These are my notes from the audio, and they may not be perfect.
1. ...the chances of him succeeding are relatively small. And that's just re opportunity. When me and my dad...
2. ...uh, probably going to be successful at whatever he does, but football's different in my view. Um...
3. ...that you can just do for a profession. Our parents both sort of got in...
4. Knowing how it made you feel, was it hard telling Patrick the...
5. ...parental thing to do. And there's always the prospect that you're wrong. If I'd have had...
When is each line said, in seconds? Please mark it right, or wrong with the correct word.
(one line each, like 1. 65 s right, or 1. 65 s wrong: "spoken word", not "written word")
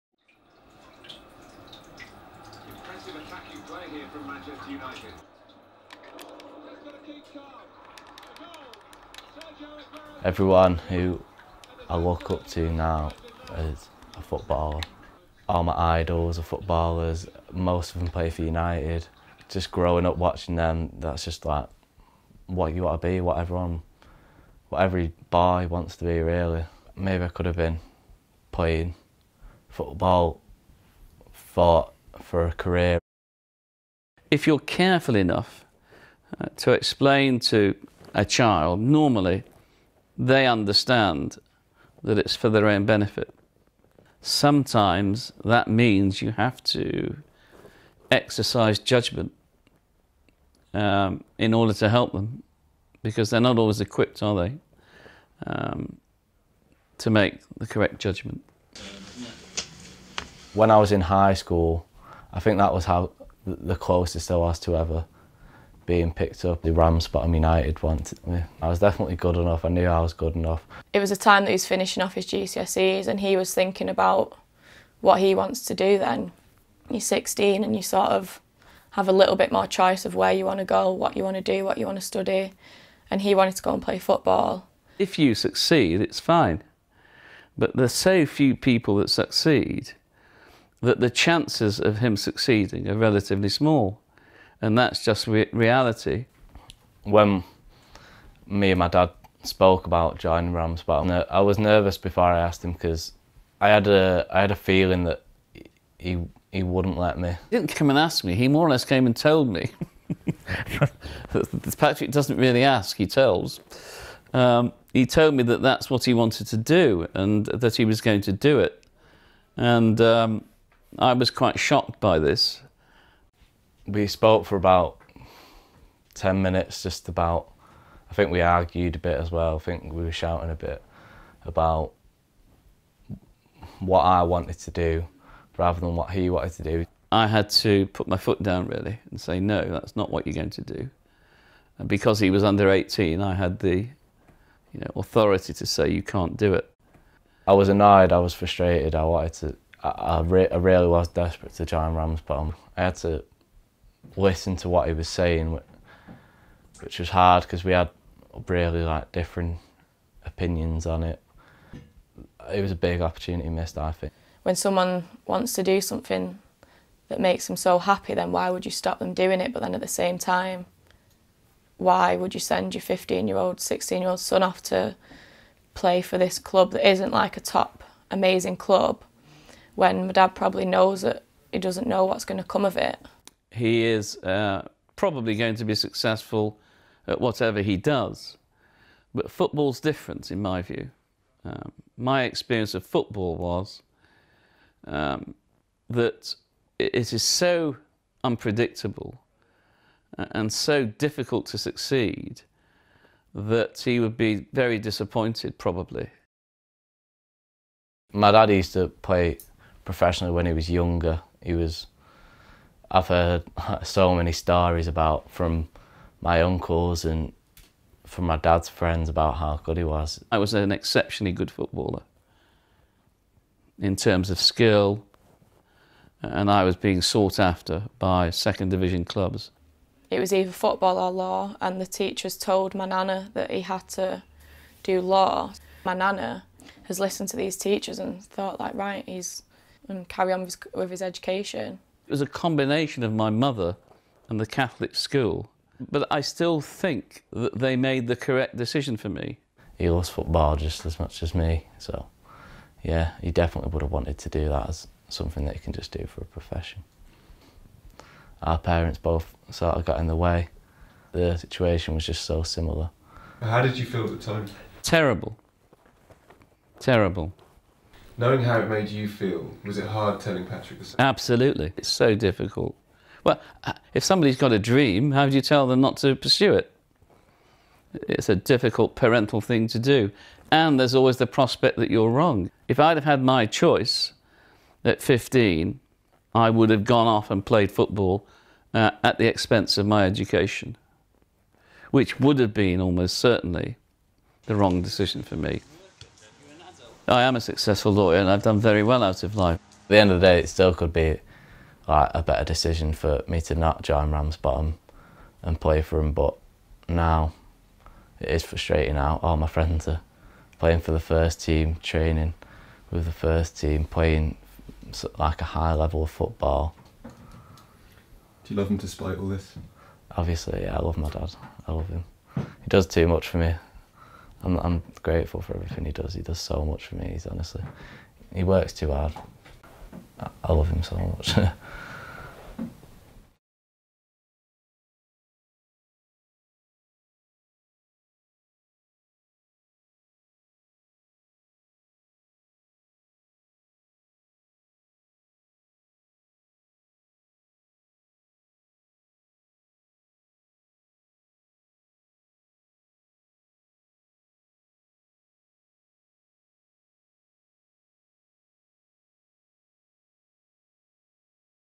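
1. 90 s wrong: "reality", not "opportunity"
2. 184 s right
3. 255 s right
4. 268 s right
5. 278 s right.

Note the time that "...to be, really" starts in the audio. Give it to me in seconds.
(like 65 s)
25 s.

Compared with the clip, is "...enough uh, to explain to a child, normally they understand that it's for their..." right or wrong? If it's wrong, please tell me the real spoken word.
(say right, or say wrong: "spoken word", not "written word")
right.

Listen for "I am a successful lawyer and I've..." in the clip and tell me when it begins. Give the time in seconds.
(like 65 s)
297 s.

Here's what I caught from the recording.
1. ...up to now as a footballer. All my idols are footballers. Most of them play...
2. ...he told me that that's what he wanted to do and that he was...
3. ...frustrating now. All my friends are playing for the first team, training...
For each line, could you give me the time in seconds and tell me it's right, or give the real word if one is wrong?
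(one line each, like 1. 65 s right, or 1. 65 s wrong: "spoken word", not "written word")
1. 12 s right
2. 114 s right
3. 308 s right.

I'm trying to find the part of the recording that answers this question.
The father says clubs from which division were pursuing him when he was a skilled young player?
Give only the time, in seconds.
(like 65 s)
228 s.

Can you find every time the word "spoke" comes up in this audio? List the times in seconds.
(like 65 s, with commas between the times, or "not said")
99 s, 124 s.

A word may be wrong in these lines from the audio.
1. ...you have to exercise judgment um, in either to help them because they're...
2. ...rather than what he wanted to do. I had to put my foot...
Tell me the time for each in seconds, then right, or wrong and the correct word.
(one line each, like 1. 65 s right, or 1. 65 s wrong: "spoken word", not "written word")
1. 46 s wrong: "order", not "either"
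2. 135 s right.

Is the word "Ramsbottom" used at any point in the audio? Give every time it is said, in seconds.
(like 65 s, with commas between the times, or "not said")
100 s, 151 s, 304 s.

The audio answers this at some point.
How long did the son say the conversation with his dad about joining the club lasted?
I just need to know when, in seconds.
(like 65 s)
126 s.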